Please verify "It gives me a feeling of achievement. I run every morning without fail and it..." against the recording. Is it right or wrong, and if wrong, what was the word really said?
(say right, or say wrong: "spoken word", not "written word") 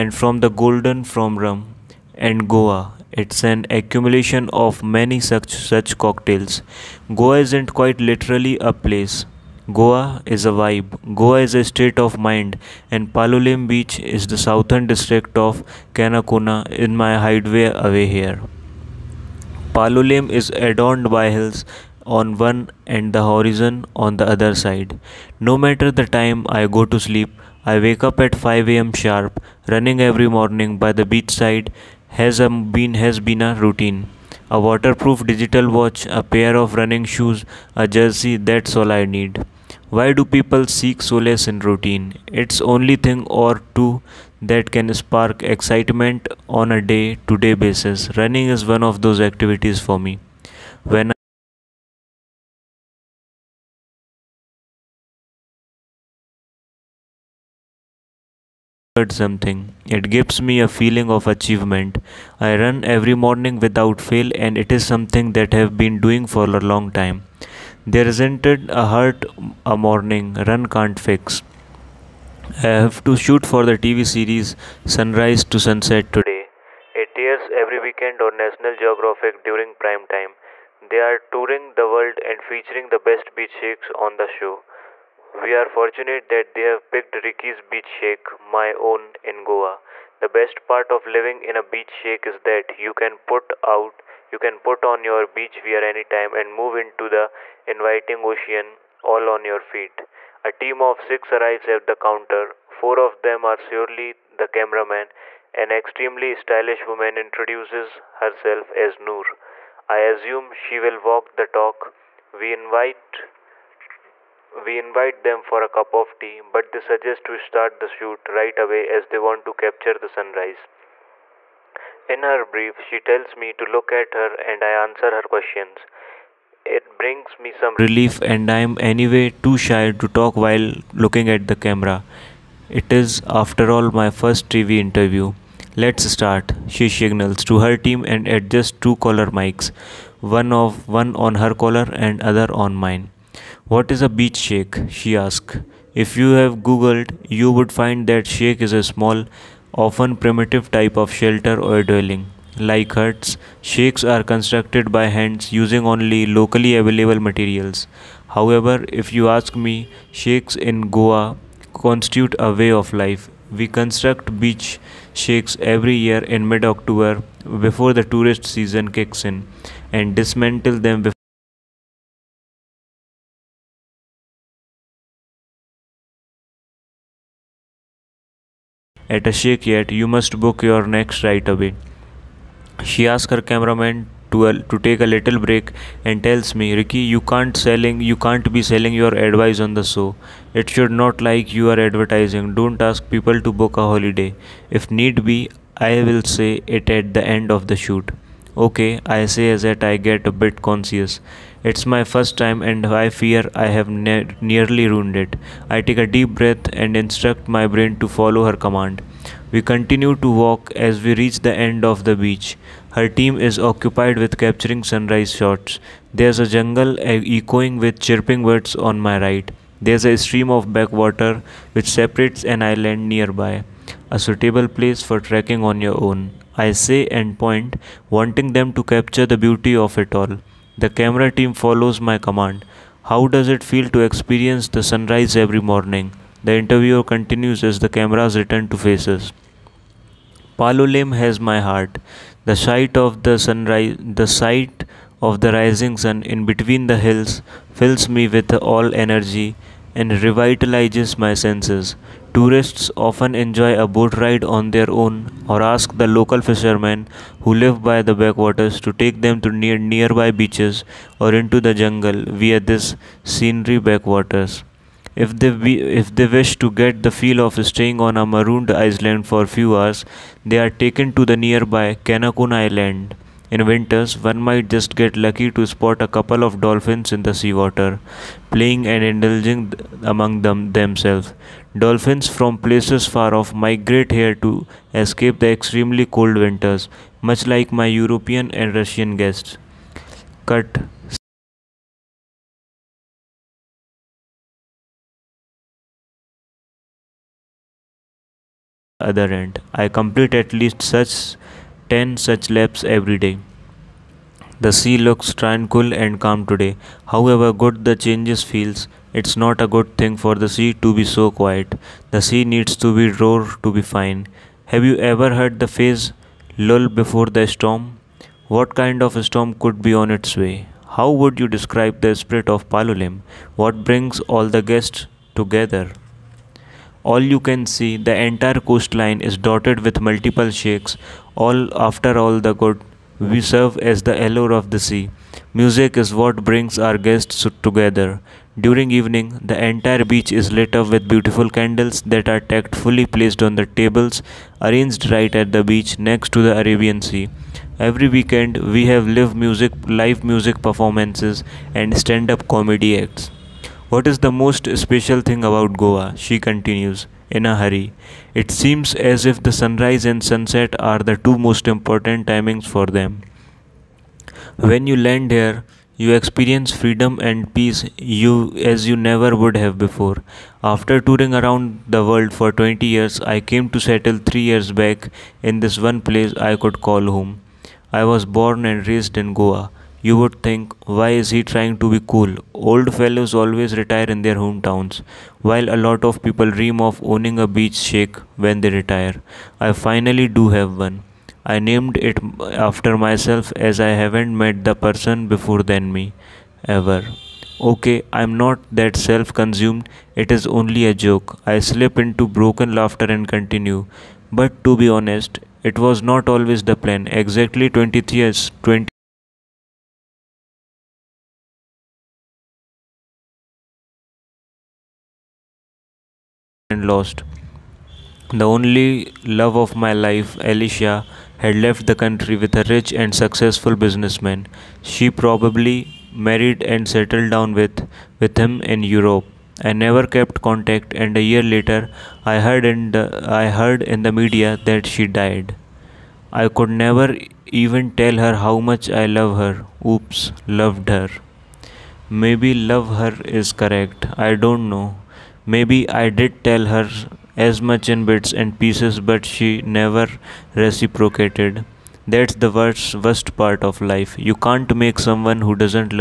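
right.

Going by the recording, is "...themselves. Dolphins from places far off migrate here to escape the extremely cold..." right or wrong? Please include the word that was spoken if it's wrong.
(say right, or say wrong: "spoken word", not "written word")
right.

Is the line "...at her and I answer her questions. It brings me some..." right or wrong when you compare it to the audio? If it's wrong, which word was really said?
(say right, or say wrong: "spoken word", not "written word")
right.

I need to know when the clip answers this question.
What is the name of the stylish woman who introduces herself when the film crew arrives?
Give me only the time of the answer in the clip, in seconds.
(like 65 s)
108 s.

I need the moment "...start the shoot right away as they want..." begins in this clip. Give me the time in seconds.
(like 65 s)
117 s.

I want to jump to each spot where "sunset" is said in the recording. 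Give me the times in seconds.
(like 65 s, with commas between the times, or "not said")
75 s, 360 s.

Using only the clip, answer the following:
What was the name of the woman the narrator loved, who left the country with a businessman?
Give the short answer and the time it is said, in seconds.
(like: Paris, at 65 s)
Alicia, at 420 s.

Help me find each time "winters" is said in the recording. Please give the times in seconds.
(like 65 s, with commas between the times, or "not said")
273 s, 286 s.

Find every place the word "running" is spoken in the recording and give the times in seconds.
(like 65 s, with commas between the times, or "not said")
29 s, 36 s, 48 s.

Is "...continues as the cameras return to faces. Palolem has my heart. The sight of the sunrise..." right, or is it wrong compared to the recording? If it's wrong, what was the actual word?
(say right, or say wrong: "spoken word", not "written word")
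right.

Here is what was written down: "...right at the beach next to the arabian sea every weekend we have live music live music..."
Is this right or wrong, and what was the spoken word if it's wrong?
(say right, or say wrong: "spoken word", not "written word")
right.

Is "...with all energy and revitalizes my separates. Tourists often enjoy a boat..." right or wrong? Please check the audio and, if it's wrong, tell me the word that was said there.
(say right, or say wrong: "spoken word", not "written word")
wrong: "senses", not "separates".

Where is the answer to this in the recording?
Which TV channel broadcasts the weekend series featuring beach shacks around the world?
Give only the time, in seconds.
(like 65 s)
78 s.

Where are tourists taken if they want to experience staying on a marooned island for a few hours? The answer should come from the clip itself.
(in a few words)
Canacona Island.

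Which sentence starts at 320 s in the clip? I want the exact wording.
How would you describe the spirit of Palolem?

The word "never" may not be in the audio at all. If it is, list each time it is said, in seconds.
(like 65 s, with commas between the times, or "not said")
368 s, 429 s, 436 s, 449 s.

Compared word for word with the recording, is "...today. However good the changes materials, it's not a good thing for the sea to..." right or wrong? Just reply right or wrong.
wrong.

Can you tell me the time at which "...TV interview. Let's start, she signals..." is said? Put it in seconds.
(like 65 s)
134 s.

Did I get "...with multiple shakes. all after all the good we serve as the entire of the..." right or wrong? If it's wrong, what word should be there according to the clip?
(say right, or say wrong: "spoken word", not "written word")
wrong: "allure", not "entire".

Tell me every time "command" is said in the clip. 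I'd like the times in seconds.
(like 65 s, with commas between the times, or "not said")
208 s, 232 s.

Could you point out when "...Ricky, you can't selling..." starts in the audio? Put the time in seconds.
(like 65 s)
186 s.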